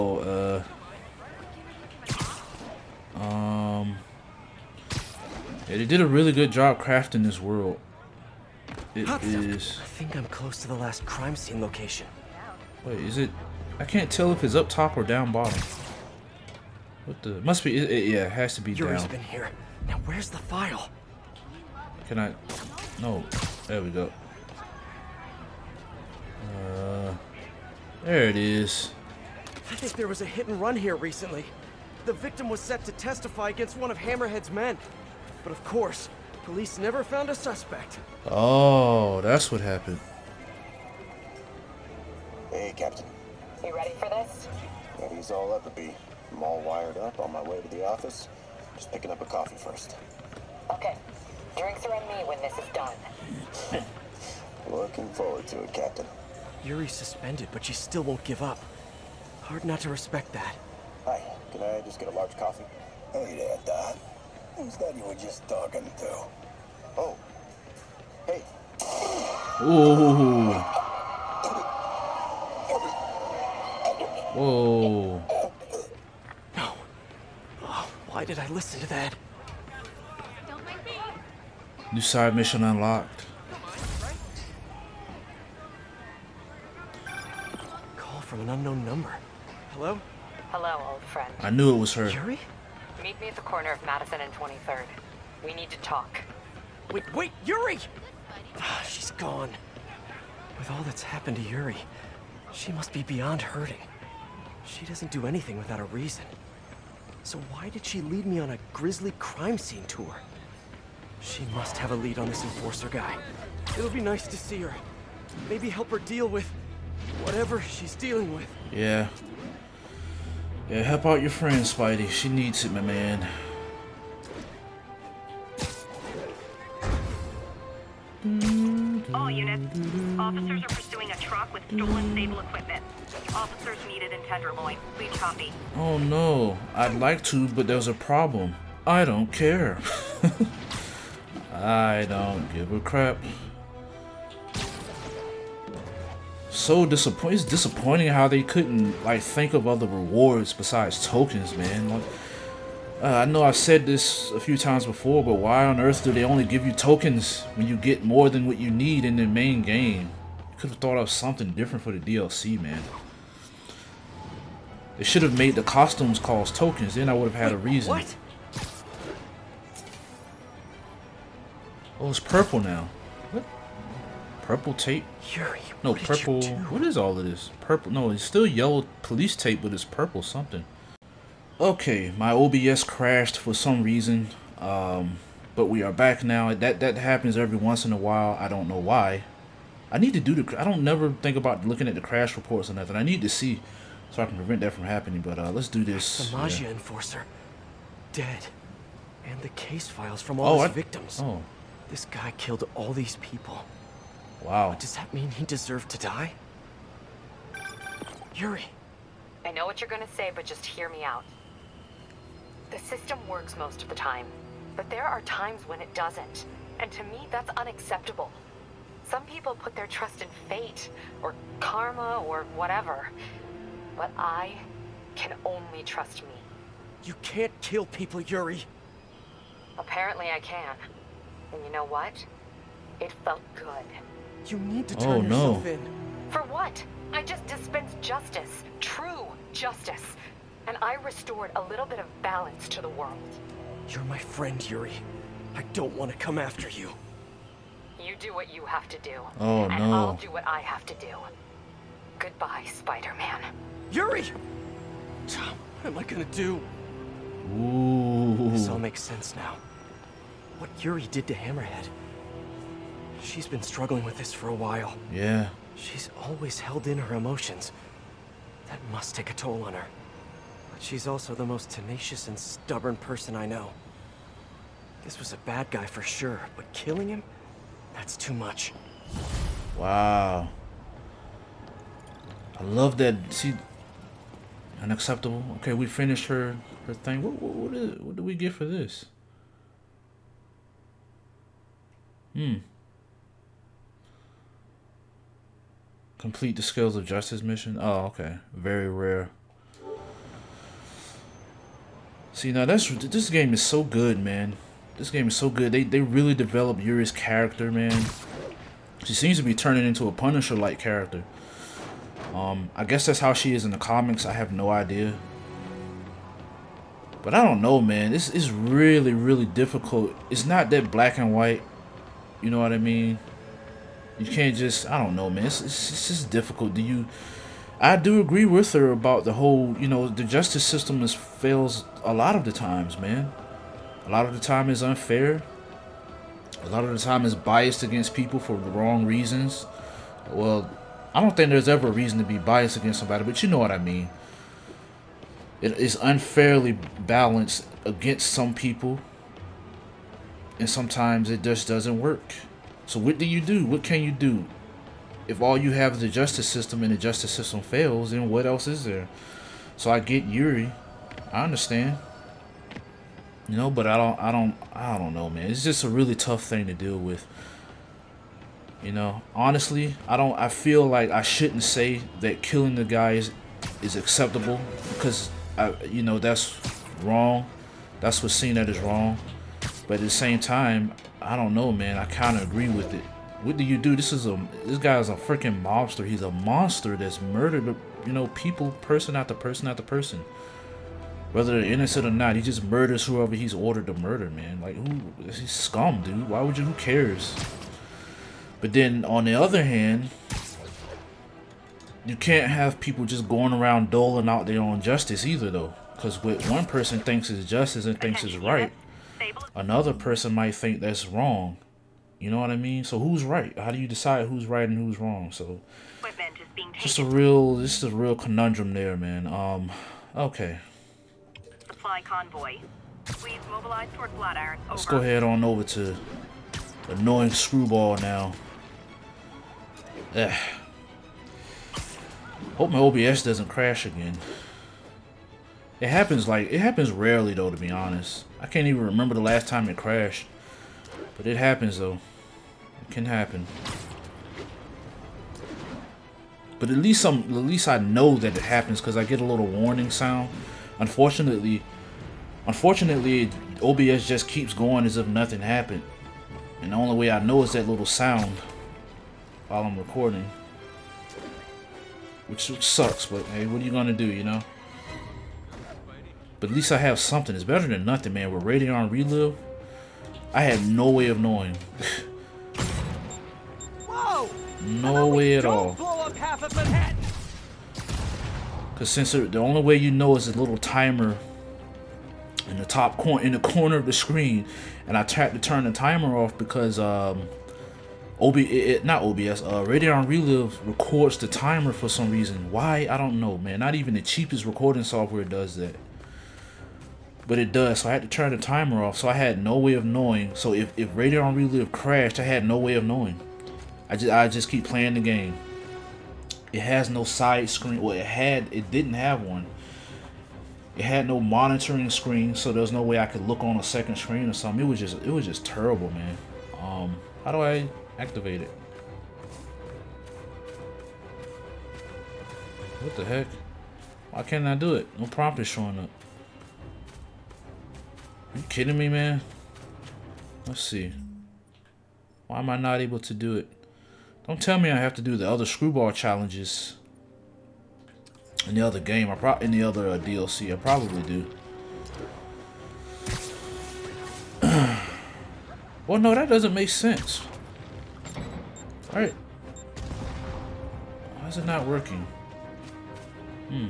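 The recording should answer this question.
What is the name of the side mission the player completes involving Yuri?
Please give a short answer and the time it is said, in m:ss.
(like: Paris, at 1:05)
Scales of Justice, at 4:56.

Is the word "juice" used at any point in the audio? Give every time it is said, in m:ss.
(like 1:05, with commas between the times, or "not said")
not said.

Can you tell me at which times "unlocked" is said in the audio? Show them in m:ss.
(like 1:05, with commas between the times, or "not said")
1:22.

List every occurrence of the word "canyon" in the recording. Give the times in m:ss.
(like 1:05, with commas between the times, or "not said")
not said.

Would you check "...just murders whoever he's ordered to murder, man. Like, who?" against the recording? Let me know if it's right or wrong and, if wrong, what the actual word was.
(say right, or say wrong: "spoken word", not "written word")
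right.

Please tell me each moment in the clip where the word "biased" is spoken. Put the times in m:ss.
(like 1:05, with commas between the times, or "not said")
5:37, 5:42.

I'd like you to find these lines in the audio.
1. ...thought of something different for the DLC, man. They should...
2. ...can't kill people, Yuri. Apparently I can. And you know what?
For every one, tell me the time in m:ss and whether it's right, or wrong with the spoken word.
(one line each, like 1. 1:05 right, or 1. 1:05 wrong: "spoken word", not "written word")
1. 2:40 right
2. 3:47 right.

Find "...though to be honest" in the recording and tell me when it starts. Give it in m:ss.
7:17.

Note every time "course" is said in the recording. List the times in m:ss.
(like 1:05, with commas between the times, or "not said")
0:35.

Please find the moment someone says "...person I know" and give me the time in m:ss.
4:32.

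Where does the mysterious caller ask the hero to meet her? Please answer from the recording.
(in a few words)
Madison and 23rd.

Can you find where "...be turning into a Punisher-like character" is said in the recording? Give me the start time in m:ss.
5:09.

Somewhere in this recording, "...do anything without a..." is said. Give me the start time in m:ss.
1:45.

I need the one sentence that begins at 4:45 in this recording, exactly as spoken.
Okay, we finished her her thing.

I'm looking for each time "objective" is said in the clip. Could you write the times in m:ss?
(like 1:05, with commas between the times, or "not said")
not said.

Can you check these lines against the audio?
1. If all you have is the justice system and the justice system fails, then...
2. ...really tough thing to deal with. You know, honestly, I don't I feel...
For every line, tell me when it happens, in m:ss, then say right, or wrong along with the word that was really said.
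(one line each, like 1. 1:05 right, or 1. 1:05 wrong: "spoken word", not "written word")
1. 5:55 right
2. 6:05 right.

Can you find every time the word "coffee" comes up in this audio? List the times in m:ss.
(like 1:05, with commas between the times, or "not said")
0:49, 1:02.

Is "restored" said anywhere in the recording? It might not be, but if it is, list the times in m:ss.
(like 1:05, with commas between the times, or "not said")
4:00.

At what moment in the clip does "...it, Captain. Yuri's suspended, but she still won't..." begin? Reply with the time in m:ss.
0:55.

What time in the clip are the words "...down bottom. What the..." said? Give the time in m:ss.
0:15.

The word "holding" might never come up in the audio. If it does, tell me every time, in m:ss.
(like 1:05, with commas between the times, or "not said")
not said.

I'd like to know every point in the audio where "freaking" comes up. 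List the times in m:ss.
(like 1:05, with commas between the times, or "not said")
6:25.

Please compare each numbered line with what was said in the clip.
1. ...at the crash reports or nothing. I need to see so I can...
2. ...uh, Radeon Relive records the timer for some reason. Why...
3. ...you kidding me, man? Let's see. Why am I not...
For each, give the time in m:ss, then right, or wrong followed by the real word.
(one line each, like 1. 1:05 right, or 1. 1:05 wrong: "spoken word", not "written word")
1. 3:11 right
2. 8:09 right
3. 8:48 right.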